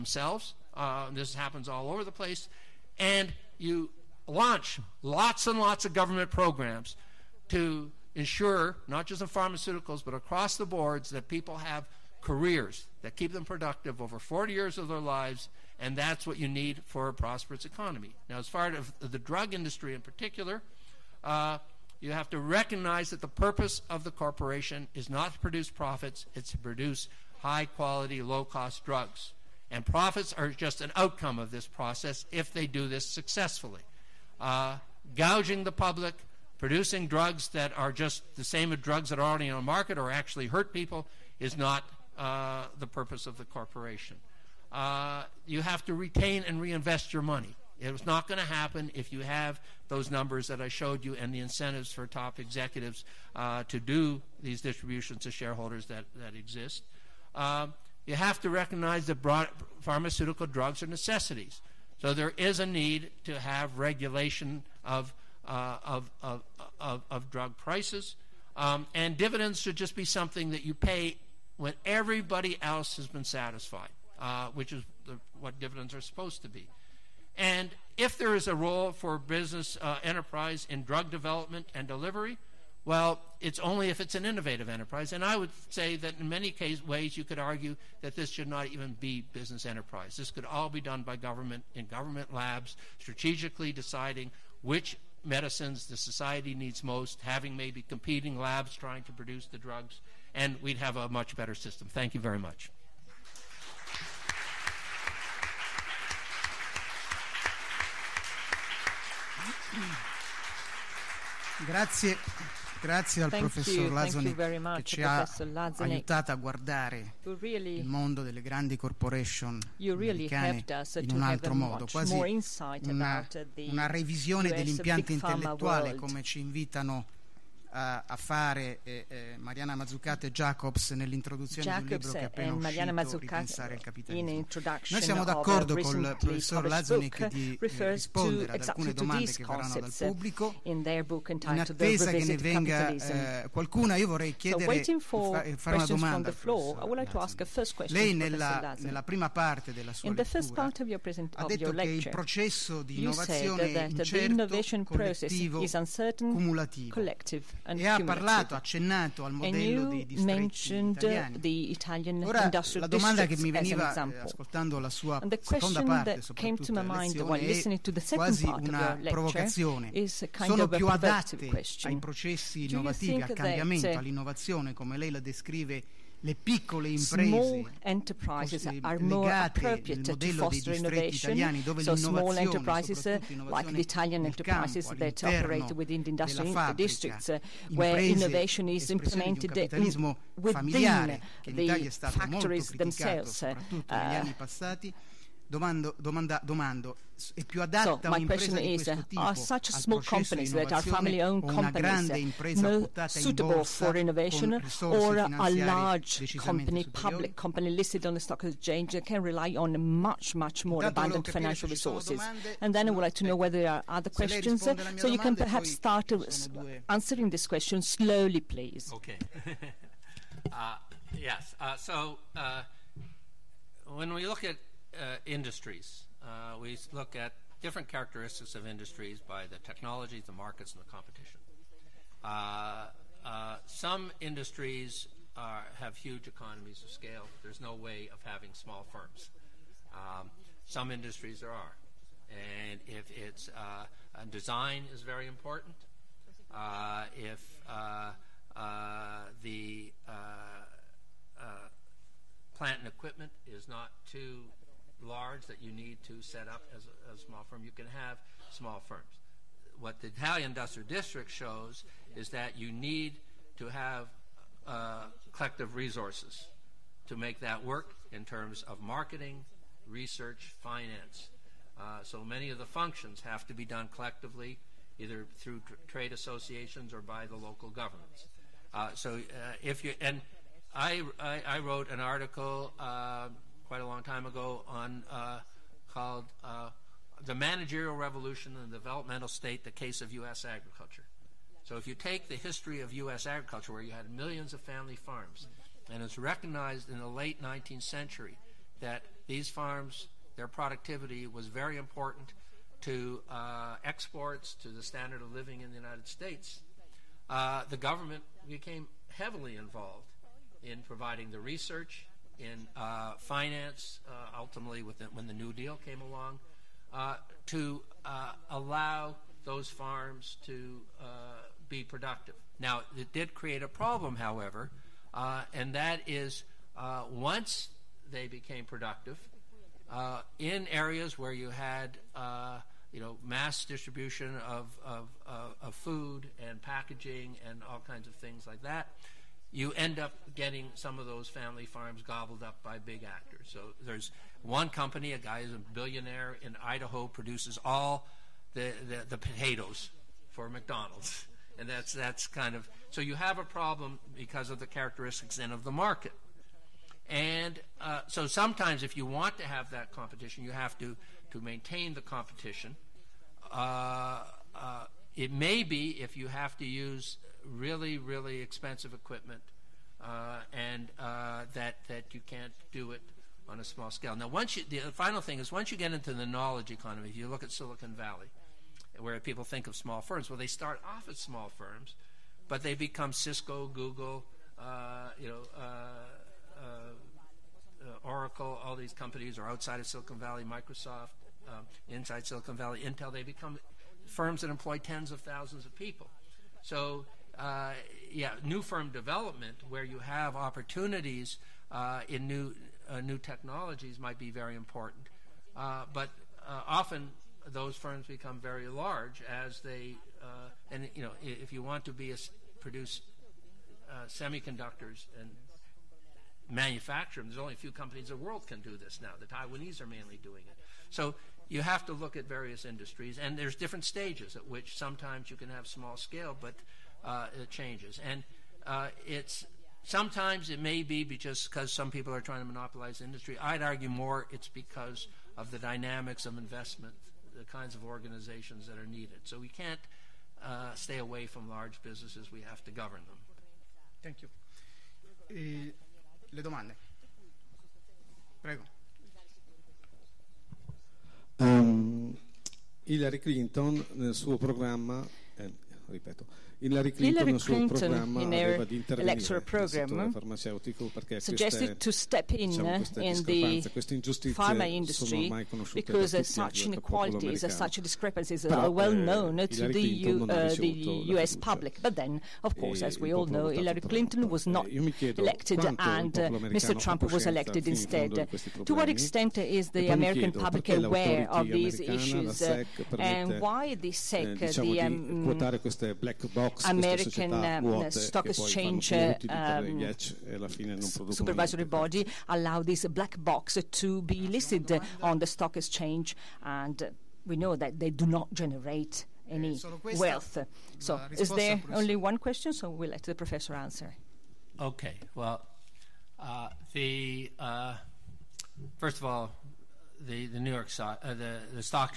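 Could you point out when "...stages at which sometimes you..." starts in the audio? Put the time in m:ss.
7:03.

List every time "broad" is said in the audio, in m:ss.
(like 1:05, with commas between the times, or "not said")
0:59.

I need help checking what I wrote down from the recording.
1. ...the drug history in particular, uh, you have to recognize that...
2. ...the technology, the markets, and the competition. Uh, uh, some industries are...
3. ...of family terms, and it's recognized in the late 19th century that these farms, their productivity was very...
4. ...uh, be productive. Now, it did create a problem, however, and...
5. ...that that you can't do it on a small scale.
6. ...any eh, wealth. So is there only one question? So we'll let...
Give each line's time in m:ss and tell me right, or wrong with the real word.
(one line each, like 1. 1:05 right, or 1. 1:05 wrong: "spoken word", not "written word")
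1. 0:18 wrong: "industry", not "history"
2. 3:49 right
3. 4:54 wrong: "farms", not "terms"
4. 5:20 right
5. 6:11 right
6. 8:19 right.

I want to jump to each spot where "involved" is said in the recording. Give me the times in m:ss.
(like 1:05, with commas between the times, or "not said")
5:09.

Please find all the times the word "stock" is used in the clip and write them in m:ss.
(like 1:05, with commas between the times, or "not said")
3:28, 8:07, 8:15, 8:30.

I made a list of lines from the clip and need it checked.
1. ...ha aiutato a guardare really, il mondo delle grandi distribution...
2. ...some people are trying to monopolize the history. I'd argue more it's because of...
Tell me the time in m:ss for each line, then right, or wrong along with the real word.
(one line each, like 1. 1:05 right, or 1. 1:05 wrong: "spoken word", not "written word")
1. 1:55 wrong: "corporation", not "distribution"
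2. 7:11 wrong: "industry", not "history".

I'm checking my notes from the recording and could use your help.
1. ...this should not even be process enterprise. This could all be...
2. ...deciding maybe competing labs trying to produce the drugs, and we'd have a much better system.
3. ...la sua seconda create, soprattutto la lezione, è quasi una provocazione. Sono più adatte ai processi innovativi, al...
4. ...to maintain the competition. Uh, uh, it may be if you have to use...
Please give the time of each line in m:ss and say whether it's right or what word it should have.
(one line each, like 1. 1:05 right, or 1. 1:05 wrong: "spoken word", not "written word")
1. 1:28 wrong: "business", not "process"
2. 1:37 wrong: "having", not "deciding"
3. 2:44 wrong: "parte", not "create"
4. 6:01 right.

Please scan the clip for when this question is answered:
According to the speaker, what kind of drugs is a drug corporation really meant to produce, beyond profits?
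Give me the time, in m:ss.
0:27.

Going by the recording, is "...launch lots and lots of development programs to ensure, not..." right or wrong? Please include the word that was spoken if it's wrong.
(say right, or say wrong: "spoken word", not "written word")
wrong: "government", not "development".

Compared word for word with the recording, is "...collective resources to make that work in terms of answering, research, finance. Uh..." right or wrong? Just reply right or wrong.
wrong.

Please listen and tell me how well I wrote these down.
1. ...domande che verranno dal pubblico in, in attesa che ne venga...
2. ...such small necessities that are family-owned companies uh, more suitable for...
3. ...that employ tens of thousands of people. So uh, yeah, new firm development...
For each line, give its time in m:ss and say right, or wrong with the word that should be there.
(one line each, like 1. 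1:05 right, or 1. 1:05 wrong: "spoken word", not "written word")
1. 2:18 right
2. 3:19 wrong: "companies", not "necessities"
3. 6:34 right.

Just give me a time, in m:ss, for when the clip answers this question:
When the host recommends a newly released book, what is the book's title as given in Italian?
2:13.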